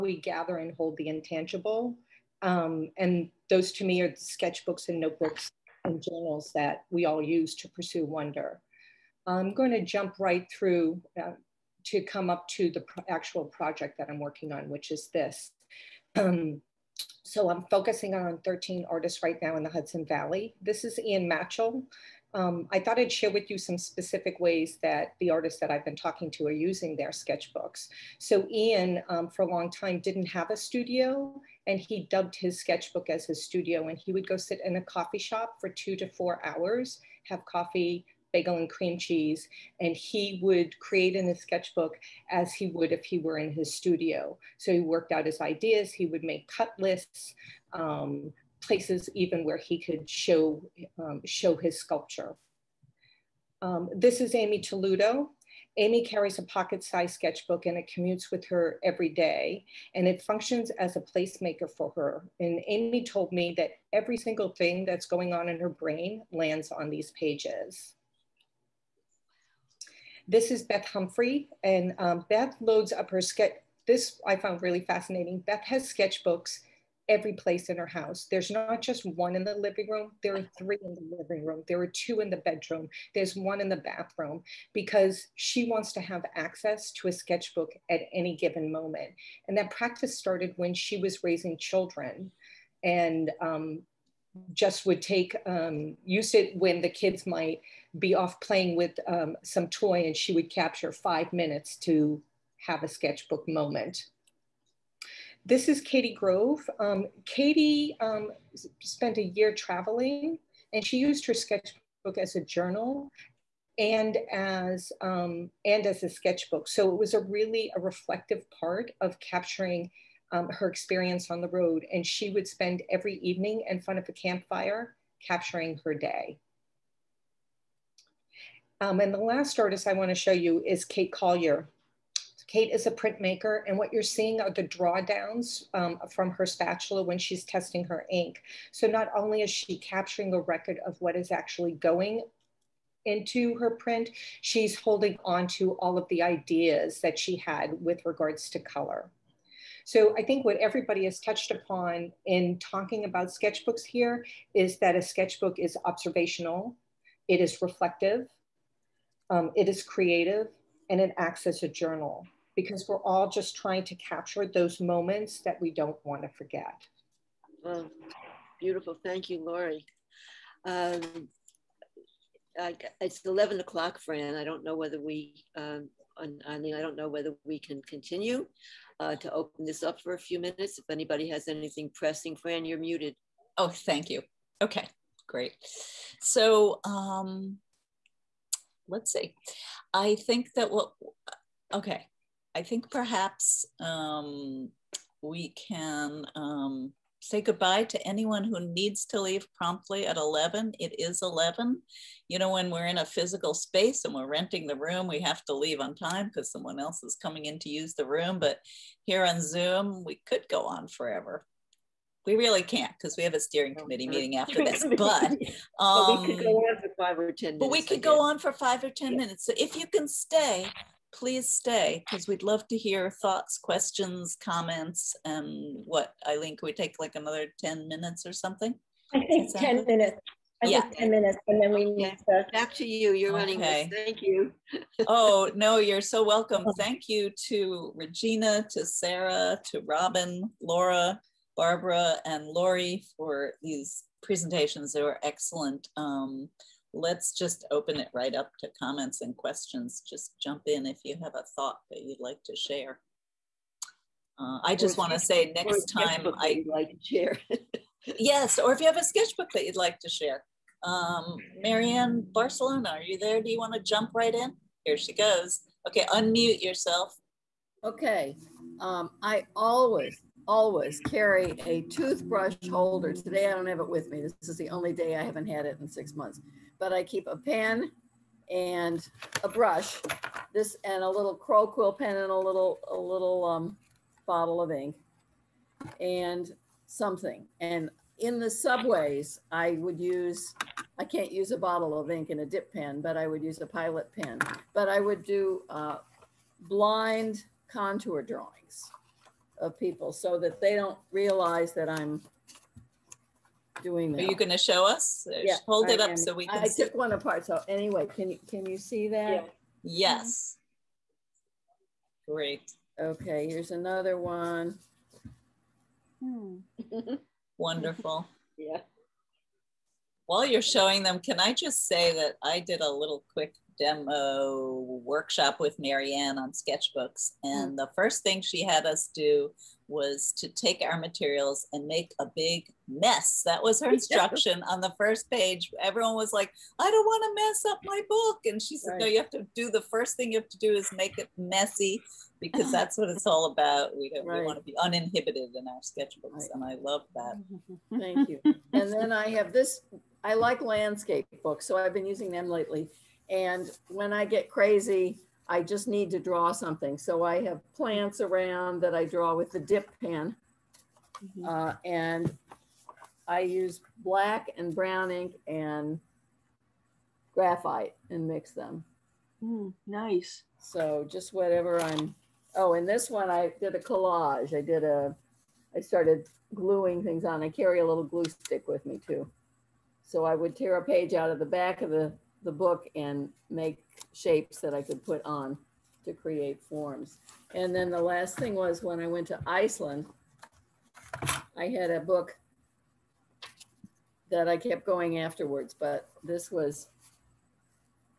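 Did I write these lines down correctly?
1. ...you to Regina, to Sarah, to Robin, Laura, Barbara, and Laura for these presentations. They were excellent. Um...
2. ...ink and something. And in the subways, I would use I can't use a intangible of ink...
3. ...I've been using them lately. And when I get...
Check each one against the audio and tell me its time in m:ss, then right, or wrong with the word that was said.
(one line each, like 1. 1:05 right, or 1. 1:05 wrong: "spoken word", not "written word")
1. 3:57 wrong: "Lori", not "Laura"
2. 4:44 wrong: "bottle", not "intangible"
3. 5:51 right.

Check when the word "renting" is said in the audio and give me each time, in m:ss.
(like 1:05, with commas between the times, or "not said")
3:24.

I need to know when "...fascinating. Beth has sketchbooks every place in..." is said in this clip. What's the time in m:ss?
1:14.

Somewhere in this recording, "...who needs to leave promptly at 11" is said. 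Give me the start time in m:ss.
3:18.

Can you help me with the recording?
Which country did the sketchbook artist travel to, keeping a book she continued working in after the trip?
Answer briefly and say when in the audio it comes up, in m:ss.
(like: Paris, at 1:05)
Iceland, at 6:29.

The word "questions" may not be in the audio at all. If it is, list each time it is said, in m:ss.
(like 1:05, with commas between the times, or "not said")
3:43, 4:09.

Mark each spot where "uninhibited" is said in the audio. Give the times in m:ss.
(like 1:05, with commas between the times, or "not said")
5:44.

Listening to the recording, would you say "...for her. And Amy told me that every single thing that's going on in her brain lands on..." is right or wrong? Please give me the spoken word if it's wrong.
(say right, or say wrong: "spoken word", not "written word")
right.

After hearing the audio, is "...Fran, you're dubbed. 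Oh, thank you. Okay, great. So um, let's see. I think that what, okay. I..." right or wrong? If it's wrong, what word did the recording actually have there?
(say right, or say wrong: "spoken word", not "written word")
wrong: "muted", not "dubbed".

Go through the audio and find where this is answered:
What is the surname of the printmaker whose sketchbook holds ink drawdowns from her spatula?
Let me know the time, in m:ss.
2:10.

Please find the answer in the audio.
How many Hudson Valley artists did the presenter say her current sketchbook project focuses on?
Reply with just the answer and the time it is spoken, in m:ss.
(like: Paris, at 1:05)
13, at 0:18.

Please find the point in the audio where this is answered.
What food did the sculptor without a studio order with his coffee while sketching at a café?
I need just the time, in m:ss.
0:38.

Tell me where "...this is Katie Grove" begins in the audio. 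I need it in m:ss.
1:45.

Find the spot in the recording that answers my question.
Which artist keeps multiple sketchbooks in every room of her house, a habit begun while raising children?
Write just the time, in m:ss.
1:10.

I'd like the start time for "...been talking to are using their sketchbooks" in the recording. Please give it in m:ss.
0:25.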